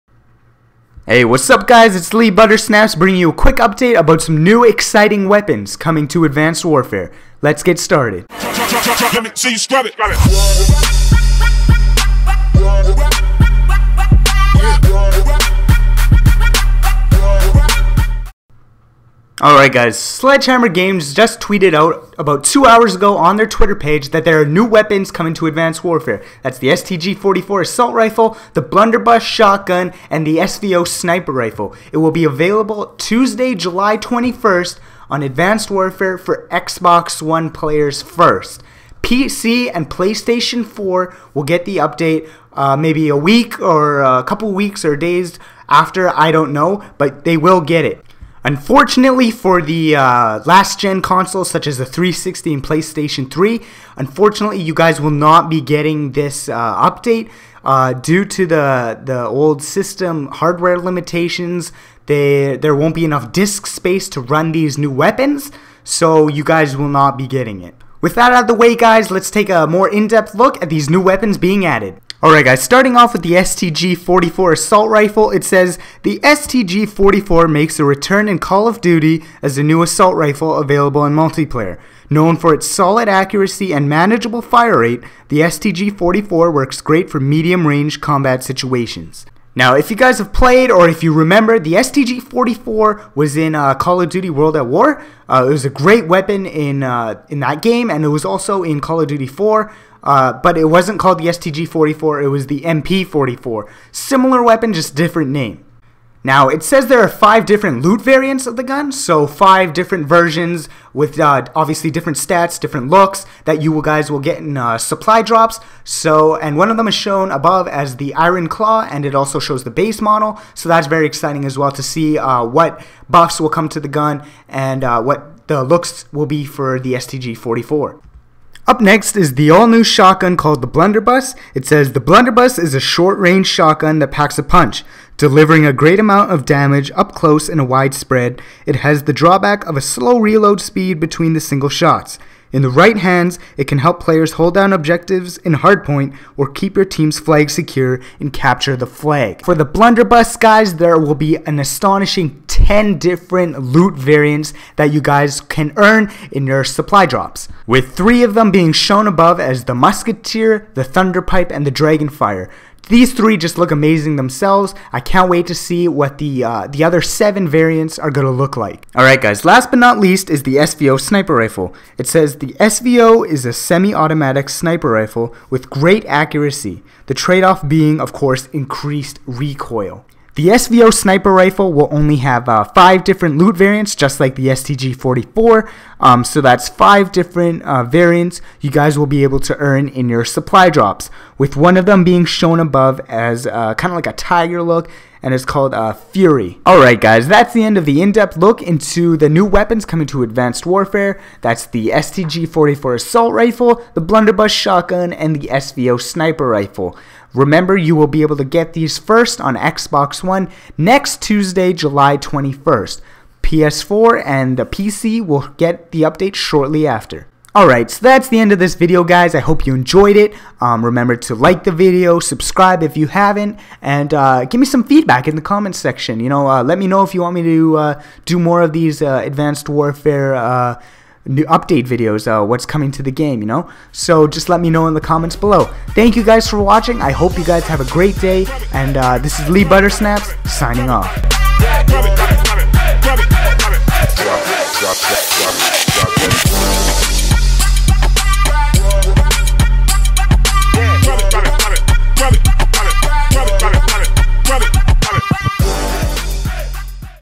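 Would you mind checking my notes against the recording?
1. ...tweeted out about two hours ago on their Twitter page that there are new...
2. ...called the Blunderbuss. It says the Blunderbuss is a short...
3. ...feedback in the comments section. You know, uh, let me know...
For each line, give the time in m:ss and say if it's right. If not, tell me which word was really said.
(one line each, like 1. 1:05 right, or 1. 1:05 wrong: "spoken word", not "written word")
1. 0:21 right
2. 2:10 right
3. 3:44 right.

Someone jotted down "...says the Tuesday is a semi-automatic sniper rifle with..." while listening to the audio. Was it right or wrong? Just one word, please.
wrong.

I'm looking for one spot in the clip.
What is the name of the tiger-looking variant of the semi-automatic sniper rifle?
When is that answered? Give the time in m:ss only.
3:15.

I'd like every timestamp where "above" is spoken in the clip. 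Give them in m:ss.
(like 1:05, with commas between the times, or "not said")
1:57, 2:39, 3:12.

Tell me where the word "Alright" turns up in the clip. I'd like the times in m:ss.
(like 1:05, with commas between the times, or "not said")
0:19, 1:12, 2:48, 3:16, 3:37.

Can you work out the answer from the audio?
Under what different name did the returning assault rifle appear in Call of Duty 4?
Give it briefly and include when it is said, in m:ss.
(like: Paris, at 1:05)
MP 44, at 1:42.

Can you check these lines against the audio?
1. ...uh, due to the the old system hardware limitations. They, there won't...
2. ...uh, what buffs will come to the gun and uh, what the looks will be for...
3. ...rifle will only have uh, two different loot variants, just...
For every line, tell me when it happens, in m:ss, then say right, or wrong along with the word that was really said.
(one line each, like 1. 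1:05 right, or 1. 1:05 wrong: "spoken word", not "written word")
1. 0:57 right
2. 2:02 right
3. 3:01 wrong: "five", not "two".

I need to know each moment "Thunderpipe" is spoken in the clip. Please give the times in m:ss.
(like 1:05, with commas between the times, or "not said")
2:40.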